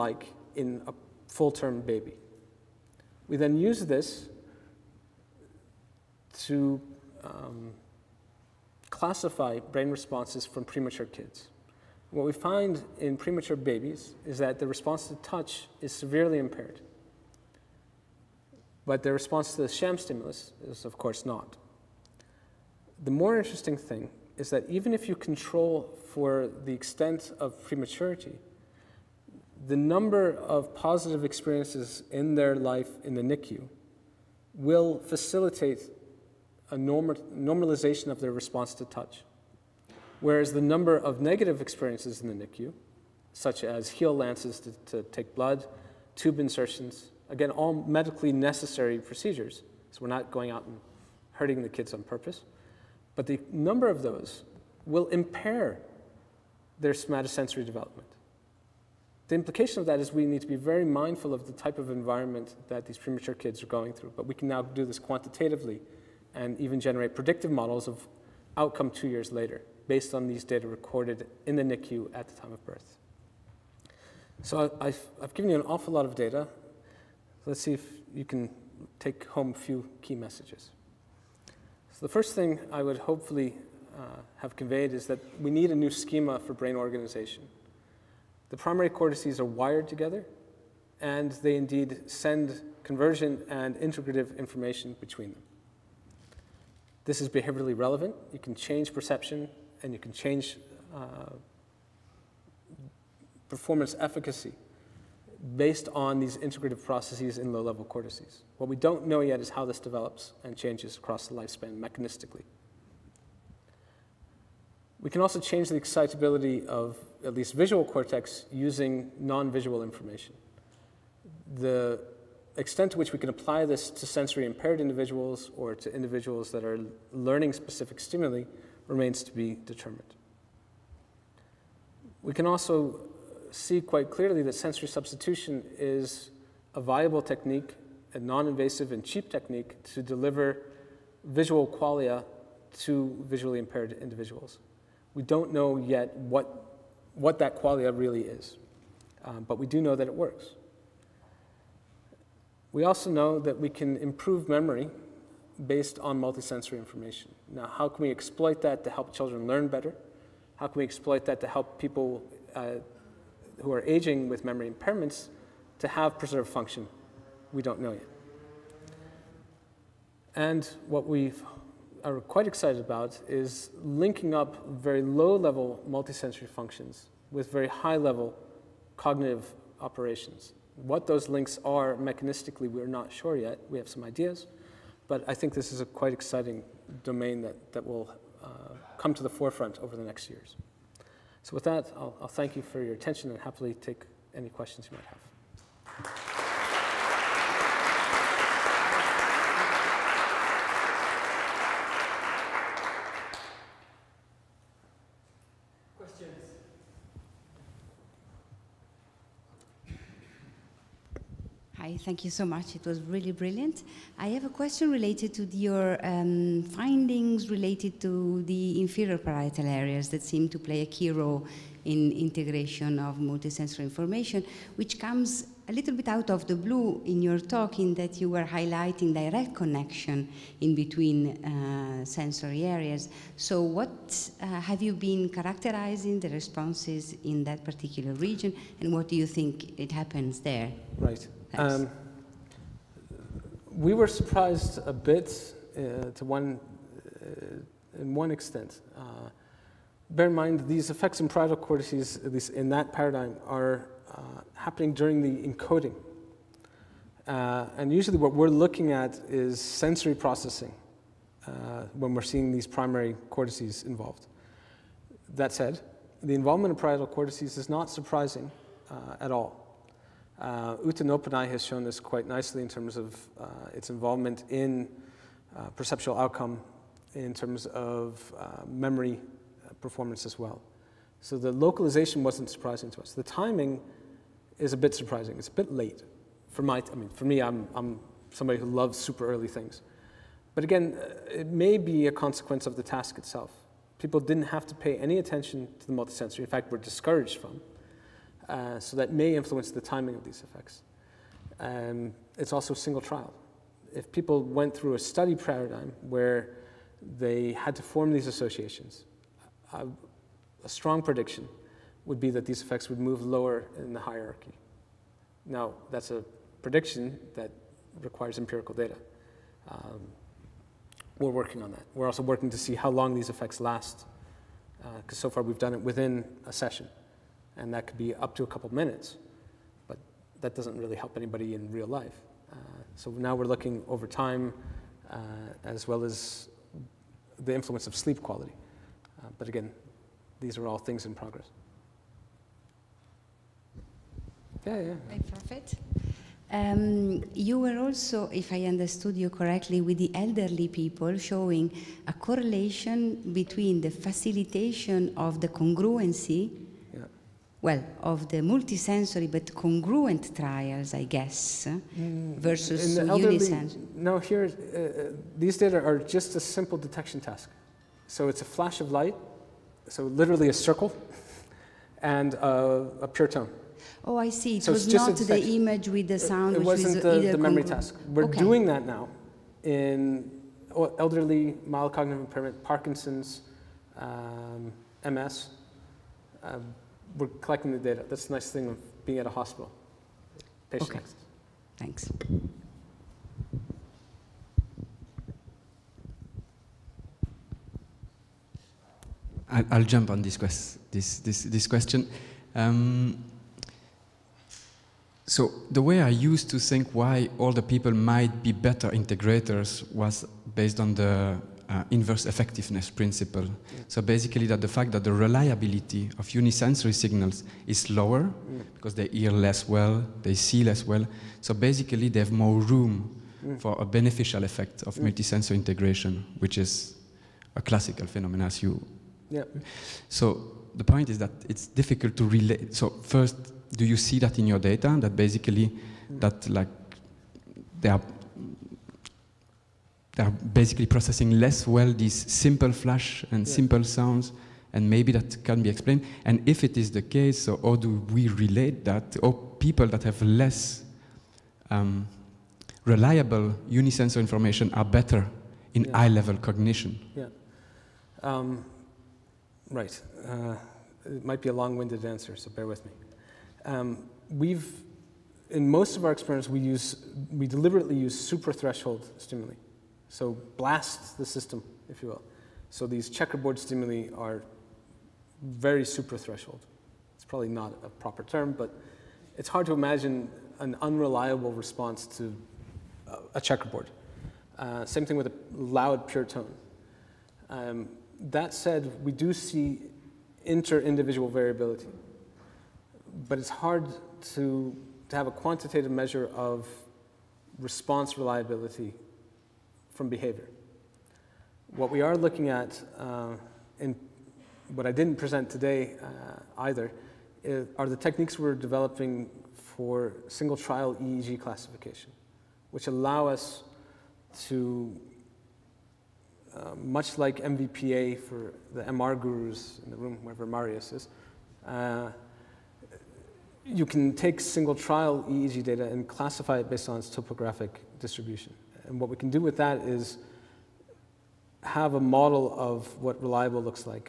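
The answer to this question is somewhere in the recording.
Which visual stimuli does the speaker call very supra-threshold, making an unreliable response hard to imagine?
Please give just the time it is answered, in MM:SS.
07:53.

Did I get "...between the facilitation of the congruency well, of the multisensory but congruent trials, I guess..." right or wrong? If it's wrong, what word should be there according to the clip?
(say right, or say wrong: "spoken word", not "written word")
right.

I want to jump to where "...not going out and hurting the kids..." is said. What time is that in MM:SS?
00:50.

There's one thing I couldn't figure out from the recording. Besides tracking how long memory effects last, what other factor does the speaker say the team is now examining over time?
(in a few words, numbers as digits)
sleep quality.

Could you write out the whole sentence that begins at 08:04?
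Uh, same thing with a loud pure tone.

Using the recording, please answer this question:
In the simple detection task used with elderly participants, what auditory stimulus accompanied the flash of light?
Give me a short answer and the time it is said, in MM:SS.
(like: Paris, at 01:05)
a pure tone, at 06:12.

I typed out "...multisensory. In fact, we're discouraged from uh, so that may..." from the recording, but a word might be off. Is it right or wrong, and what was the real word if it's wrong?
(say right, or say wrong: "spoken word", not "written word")
right.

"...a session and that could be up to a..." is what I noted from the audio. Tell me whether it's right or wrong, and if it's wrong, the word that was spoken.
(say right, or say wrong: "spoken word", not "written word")
right.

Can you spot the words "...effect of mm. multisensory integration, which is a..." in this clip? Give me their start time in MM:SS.
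07:04.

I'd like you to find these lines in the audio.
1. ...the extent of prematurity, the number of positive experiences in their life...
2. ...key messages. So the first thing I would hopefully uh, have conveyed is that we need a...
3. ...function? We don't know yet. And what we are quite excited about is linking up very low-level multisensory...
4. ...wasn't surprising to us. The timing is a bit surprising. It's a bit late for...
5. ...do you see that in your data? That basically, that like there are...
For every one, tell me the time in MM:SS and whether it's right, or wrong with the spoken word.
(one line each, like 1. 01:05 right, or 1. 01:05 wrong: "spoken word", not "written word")
1. 00:26 right
2. 01:20 right
3. 02:46 right
4. 04:42 right
5. 07:13 right.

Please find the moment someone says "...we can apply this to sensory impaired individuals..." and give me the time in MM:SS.
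02:03.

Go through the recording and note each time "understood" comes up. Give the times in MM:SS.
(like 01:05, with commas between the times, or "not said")
05:48.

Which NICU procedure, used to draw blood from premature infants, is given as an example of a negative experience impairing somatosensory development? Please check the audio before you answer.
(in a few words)
heel lances.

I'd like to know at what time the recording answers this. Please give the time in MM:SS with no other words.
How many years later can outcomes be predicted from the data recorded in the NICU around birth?
01:08.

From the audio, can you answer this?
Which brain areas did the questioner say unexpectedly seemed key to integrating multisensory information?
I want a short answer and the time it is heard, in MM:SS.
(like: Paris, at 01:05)
inferior parietal areas, at 03:38.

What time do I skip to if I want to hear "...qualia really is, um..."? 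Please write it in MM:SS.
02:27.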